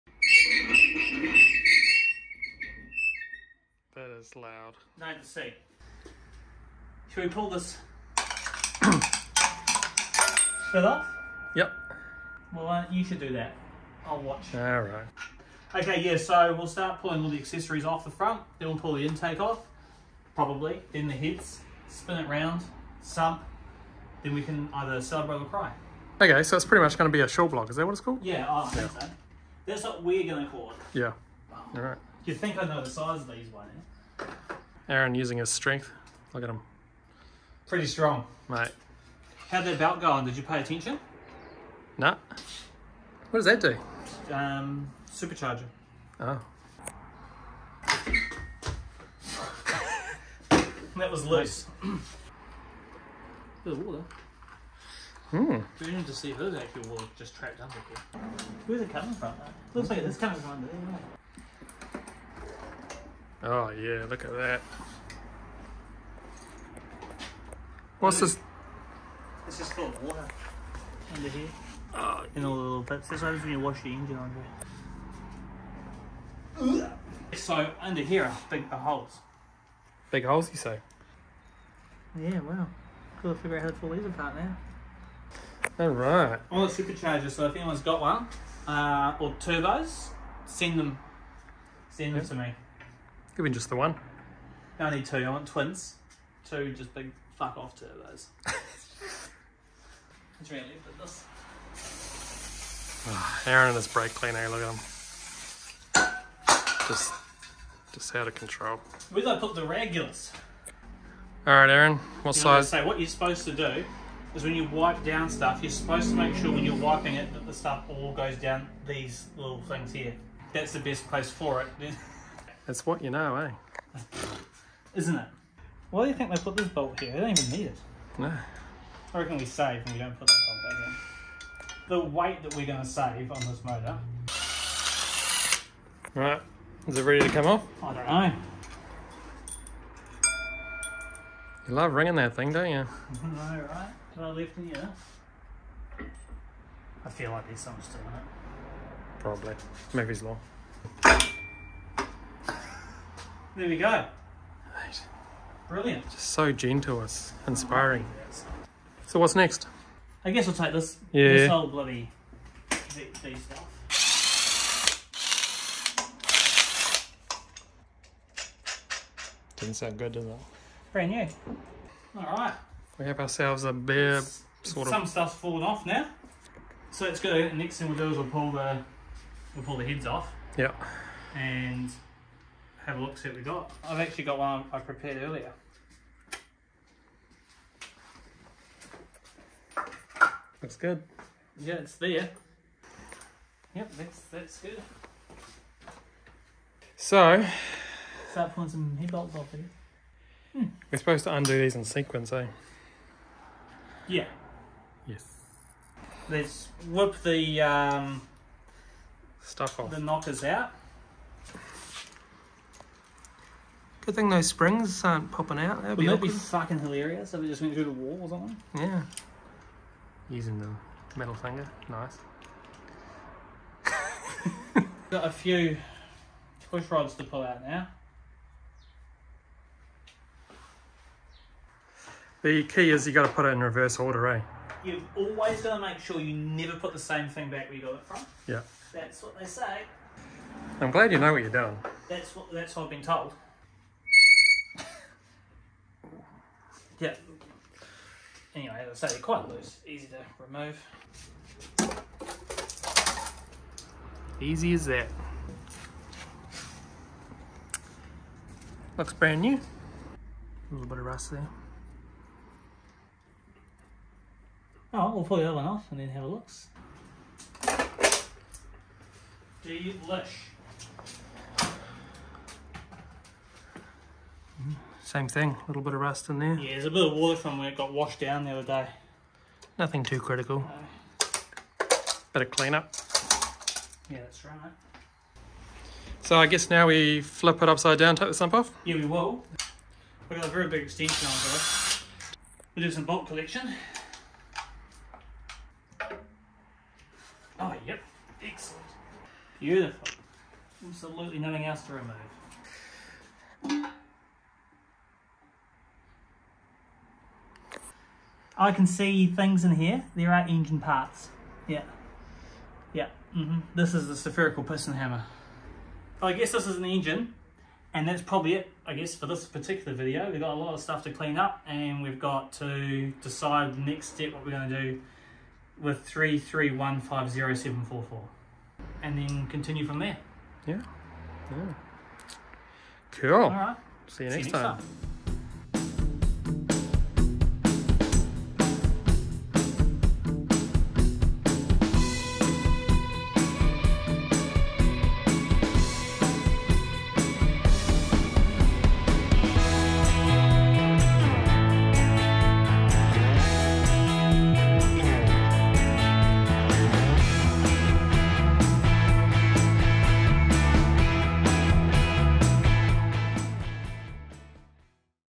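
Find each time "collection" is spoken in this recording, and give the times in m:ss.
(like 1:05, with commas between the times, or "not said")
4:53.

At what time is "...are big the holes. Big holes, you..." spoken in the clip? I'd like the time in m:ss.
1:18.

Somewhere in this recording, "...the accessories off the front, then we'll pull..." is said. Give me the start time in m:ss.
0:17.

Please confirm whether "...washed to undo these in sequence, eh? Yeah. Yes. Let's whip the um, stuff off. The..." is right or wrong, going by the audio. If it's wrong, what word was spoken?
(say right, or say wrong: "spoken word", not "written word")
wrong: "supposed", not "washed".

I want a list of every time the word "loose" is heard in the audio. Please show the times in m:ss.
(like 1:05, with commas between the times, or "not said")
0:51, 4:09.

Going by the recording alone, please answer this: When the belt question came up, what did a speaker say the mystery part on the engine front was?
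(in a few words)
supercharger.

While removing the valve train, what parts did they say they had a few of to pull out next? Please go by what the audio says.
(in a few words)
push rods.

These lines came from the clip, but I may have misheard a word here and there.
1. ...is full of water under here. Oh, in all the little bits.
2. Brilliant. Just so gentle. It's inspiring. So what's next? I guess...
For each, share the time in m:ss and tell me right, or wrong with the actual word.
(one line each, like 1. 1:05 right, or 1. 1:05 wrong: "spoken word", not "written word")
1. 1:09 right
2. 2:35 right.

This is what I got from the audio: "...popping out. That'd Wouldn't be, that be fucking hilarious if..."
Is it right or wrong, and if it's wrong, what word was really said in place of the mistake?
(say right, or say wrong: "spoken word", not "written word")
right.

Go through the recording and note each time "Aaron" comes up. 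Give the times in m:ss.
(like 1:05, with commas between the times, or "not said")
0:34, 1:43, 1:51.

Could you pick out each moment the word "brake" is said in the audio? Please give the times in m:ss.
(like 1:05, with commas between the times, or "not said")
1:43.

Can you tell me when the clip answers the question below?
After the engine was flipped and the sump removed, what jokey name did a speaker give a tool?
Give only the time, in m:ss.
5:14.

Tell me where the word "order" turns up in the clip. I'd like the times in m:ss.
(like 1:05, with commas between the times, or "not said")
3:53.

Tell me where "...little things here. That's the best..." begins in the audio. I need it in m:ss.
1:59.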